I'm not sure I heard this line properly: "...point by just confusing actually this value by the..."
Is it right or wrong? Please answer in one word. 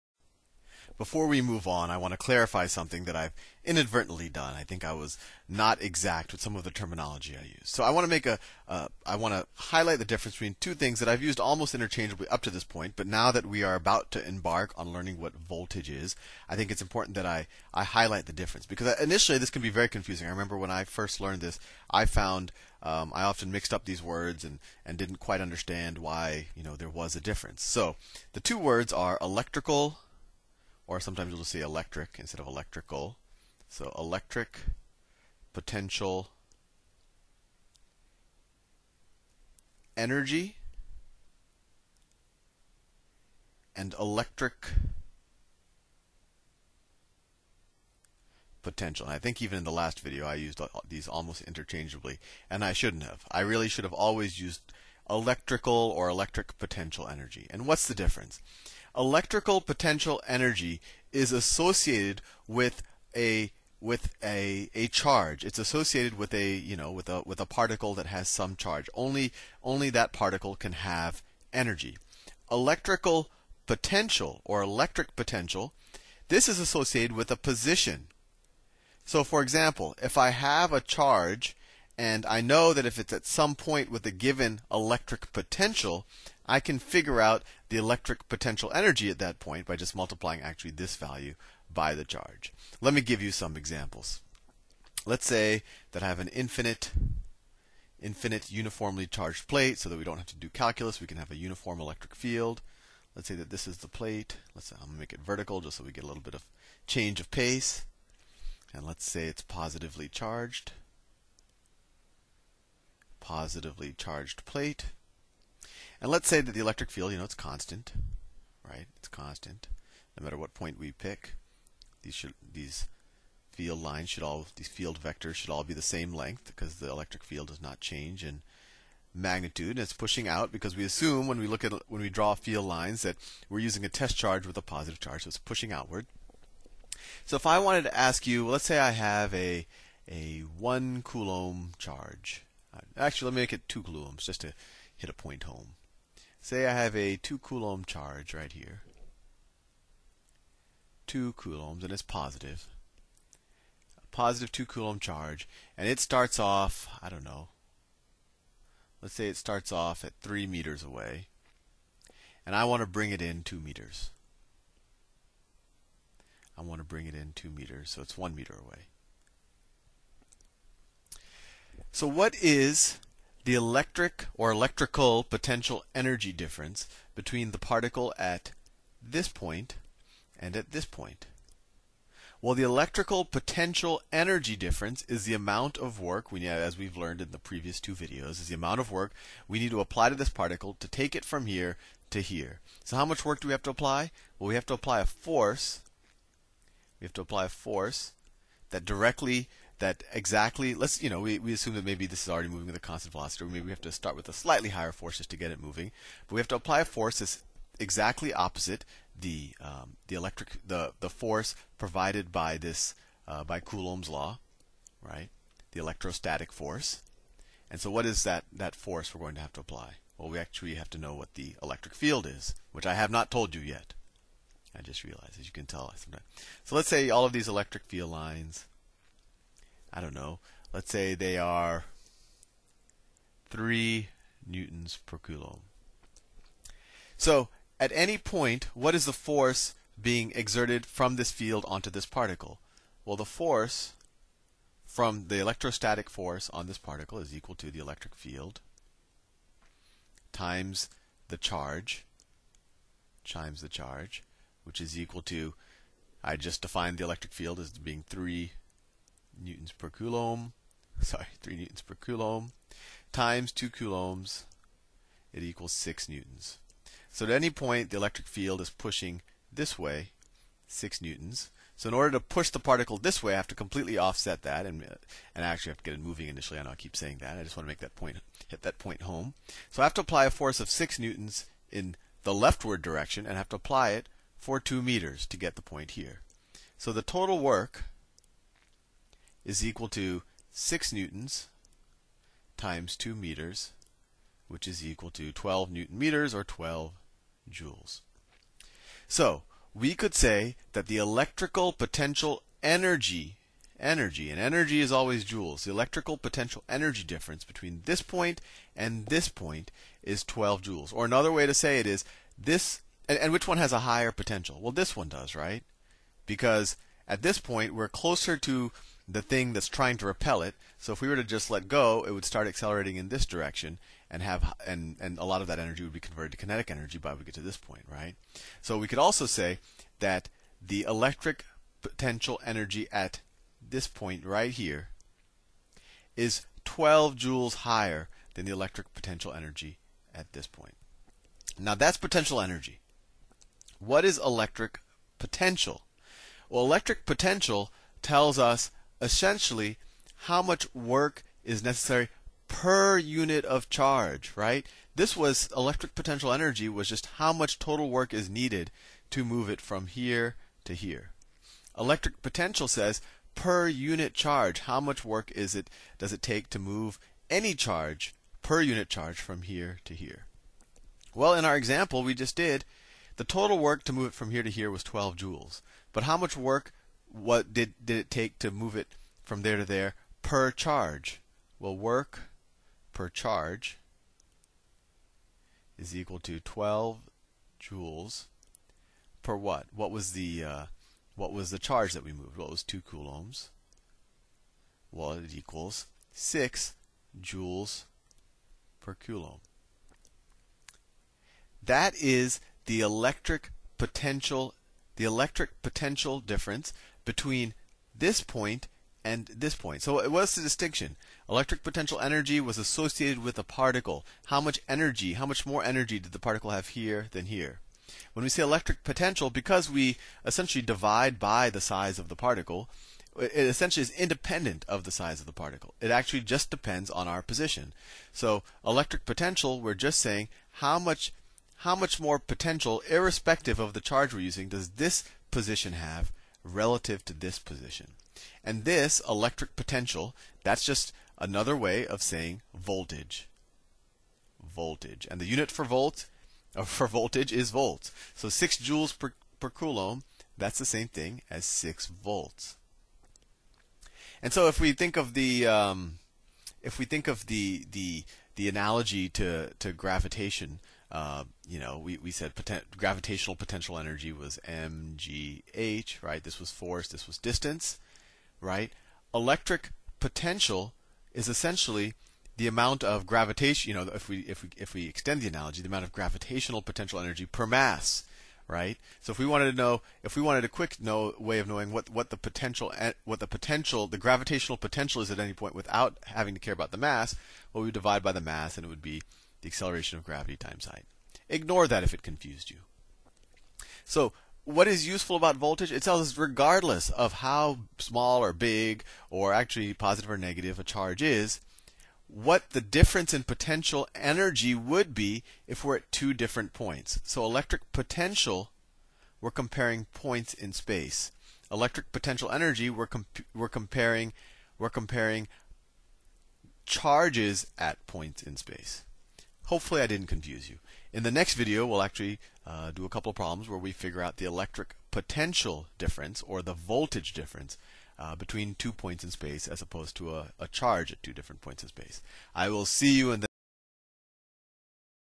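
wrong.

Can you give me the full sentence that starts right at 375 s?
But how much work what did, did it take to move it from there to there per charge?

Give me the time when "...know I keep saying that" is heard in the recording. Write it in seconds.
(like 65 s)
276 s.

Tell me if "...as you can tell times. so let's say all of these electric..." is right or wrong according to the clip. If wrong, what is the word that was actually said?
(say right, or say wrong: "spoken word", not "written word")
wrong: "sometimes", not "times".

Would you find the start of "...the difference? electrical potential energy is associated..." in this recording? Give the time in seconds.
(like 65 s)
57 s.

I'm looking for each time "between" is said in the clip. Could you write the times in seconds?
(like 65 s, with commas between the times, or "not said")
10 s, 177 s, 307 s, 407 s, 528 s.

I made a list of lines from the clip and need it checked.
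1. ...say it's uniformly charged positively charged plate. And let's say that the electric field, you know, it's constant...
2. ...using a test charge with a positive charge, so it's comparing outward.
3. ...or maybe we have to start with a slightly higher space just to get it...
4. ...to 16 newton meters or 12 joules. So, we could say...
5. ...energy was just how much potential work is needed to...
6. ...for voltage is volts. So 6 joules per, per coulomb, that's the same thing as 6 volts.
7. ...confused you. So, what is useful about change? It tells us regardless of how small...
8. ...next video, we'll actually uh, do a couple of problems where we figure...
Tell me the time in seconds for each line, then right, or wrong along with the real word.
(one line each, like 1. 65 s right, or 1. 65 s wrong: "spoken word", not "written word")
1. 109 s wrong: "positively", not "uniformly"
2. 133 s wrong: "pushing", not "comparing"
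3. 203 s wrong: "force", not "space"
4. 295 s wrong: "12", not "16"
5. 356 s wrong: "total", not "potential"
6. 446 s right
7. 492 s wrong: "voltage", not "change"
8. 521 s right.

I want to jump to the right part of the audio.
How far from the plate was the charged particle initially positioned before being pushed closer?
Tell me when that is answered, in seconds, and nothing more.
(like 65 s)
160 s.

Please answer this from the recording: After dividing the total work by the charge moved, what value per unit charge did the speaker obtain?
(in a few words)
6 joules per coulomb.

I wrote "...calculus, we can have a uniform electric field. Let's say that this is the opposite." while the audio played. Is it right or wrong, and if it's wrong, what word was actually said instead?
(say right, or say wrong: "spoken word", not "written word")
wrong: "plate", not "opposite".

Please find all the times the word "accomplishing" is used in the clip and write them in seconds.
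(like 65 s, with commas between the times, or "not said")
not said.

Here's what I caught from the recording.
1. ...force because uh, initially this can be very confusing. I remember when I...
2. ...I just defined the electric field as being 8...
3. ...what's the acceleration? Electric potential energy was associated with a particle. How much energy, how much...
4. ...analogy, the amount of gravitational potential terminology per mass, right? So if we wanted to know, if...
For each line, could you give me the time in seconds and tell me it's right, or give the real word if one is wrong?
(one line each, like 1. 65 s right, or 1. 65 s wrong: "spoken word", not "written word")
1. 18 s wrong: "difference", not "force"
2. 256 s wrong: "3", not "8"
3. 410 s wrong: "distinction", not "acceleration"
4. 475 s wrong: "energy", not "terminology".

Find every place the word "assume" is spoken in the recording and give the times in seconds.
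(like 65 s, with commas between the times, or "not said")
130 s, 201 s.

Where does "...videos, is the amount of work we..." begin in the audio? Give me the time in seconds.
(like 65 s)
187 s.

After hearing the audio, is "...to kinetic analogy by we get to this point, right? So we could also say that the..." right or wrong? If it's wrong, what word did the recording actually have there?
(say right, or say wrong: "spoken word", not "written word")
wrong: "energy", not "analogy".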